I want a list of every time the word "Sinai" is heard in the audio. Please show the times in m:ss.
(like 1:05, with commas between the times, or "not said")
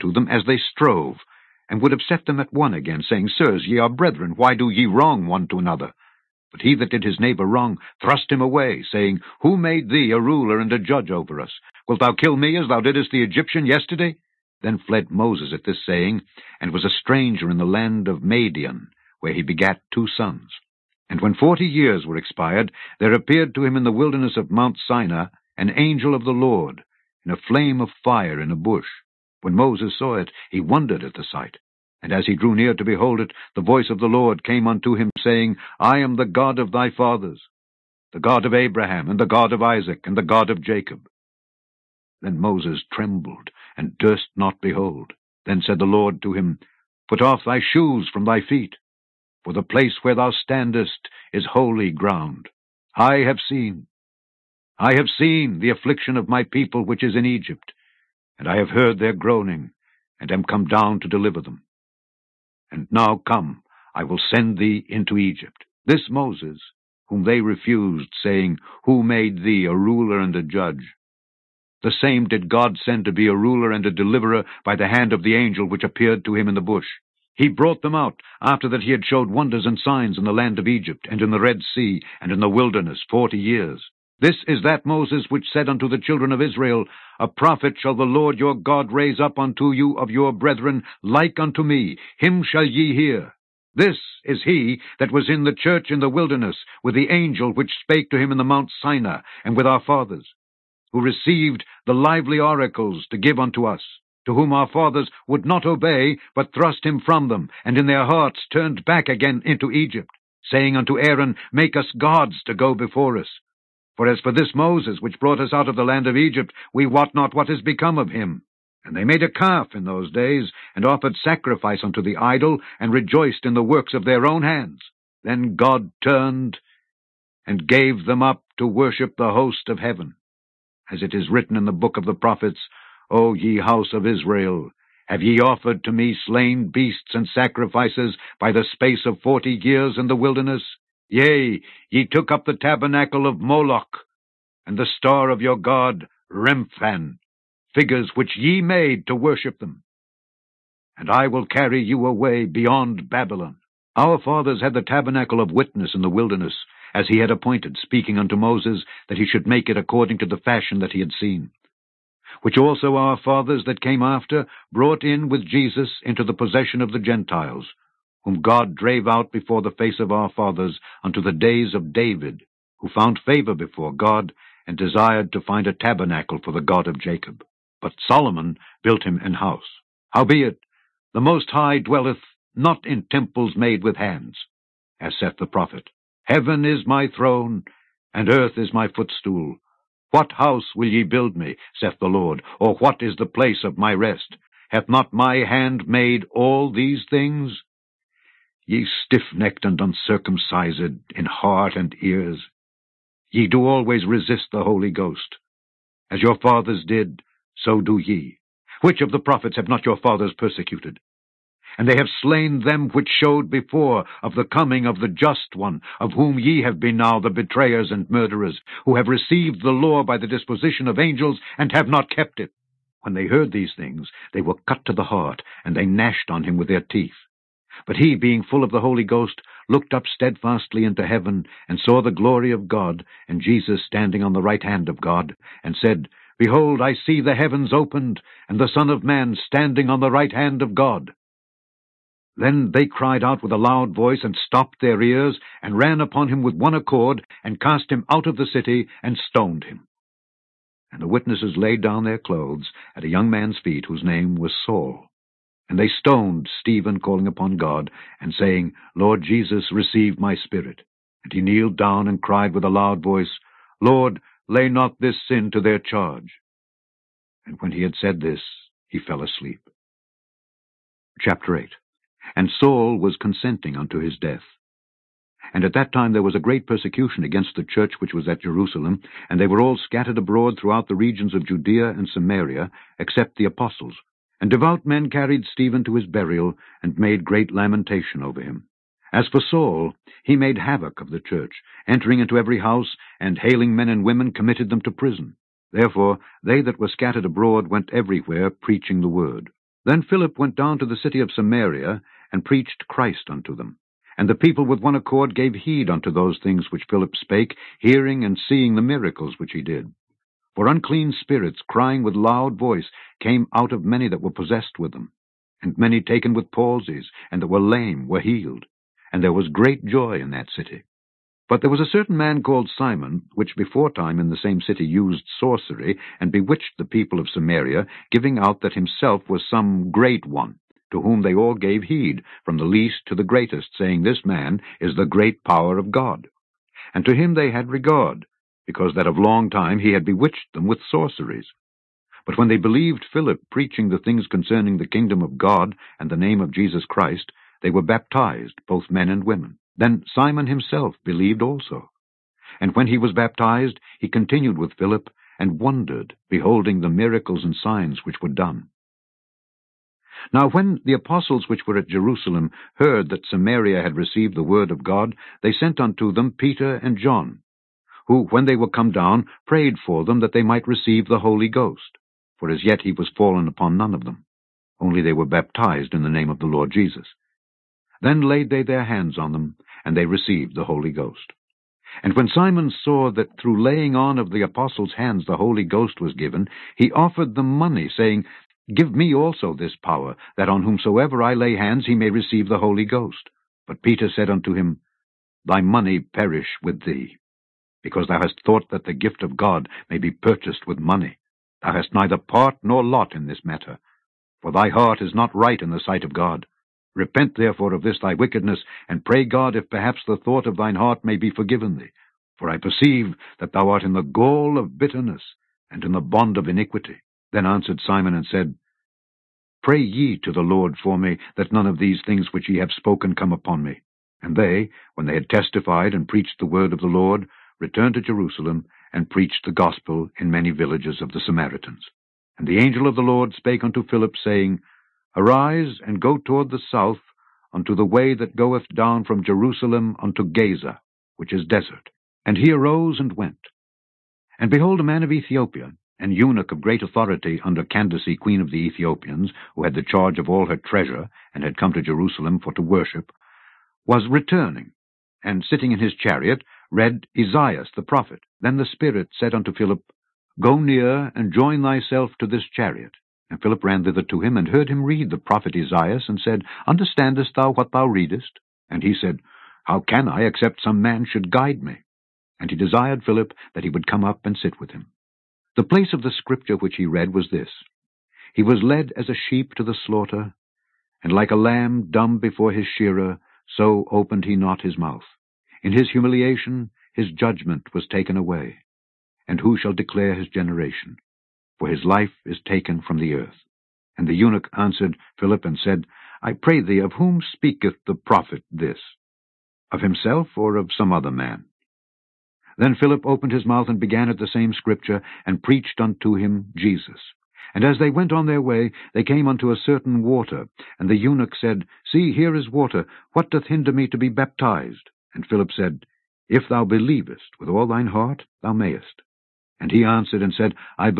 0:24, 1:38.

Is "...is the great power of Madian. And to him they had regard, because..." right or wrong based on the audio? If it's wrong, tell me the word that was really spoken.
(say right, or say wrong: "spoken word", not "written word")
wrong: "God", not "Madian".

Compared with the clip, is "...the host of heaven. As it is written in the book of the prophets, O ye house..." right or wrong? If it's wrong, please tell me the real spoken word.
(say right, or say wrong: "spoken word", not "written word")
right.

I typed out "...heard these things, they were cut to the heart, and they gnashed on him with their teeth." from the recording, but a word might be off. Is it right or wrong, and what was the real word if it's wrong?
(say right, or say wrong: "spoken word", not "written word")
right.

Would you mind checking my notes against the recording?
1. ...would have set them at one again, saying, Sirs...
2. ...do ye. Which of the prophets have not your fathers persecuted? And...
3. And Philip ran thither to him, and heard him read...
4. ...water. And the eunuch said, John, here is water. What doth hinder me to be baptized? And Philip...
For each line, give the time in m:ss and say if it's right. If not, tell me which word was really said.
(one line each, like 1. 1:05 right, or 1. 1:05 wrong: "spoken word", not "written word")
1. 0:01 right
2. 3:27 right
3. 7:43 right
4. 8:30 wrong: "See", not "John".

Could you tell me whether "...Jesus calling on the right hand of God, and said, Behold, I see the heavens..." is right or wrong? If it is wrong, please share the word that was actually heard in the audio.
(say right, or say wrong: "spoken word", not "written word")
wrong: "standing", not "calling".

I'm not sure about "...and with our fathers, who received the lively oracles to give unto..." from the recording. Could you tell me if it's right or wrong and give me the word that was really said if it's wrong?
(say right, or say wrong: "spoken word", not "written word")
right.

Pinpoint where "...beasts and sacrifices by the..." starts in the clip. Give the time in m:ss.
2:16.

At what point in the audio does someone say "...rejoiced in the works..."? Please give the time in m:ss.
2:02.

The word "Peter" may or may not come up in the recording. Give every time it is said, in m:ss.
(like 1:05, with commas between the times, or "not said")
6:06, 6:33.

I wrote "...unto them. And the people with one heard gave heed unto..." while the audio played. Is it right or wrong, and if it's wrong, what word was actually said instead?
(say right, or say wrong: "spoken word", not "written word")
wrong: "accord", not "heard".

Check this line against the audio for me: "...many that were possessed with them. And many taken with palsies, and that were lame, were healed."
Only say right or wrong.
right.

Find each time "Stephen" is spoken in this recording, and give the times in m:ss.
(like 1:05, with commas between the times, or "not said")
4:16, 4:45.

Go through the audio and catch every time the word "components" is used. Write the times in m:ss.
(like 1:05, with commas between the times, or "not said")
not said.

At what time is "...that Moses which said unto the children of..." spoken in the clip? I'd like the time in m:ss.
1:24.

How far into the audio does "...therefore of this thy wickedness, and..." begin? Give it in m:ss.
6:47.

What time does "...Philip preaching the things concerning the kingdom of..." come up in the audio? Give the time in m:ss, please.
5:43.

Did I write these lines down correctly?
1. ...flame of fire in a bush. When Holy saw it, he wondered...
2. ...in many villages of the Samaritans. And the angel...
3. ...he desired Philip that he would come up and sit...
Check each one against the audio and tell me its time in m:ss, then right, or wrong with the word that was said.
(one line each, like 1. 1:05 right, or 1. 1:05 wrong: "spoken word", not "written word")
1. 0:27 wrong: "Moses", not "Holy"
2. 7:10 right
3. 7:52 right.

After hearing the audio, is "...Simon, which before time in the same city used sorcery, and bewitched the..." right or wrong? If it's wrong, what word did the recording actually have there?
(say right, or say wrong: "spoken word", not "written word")
right.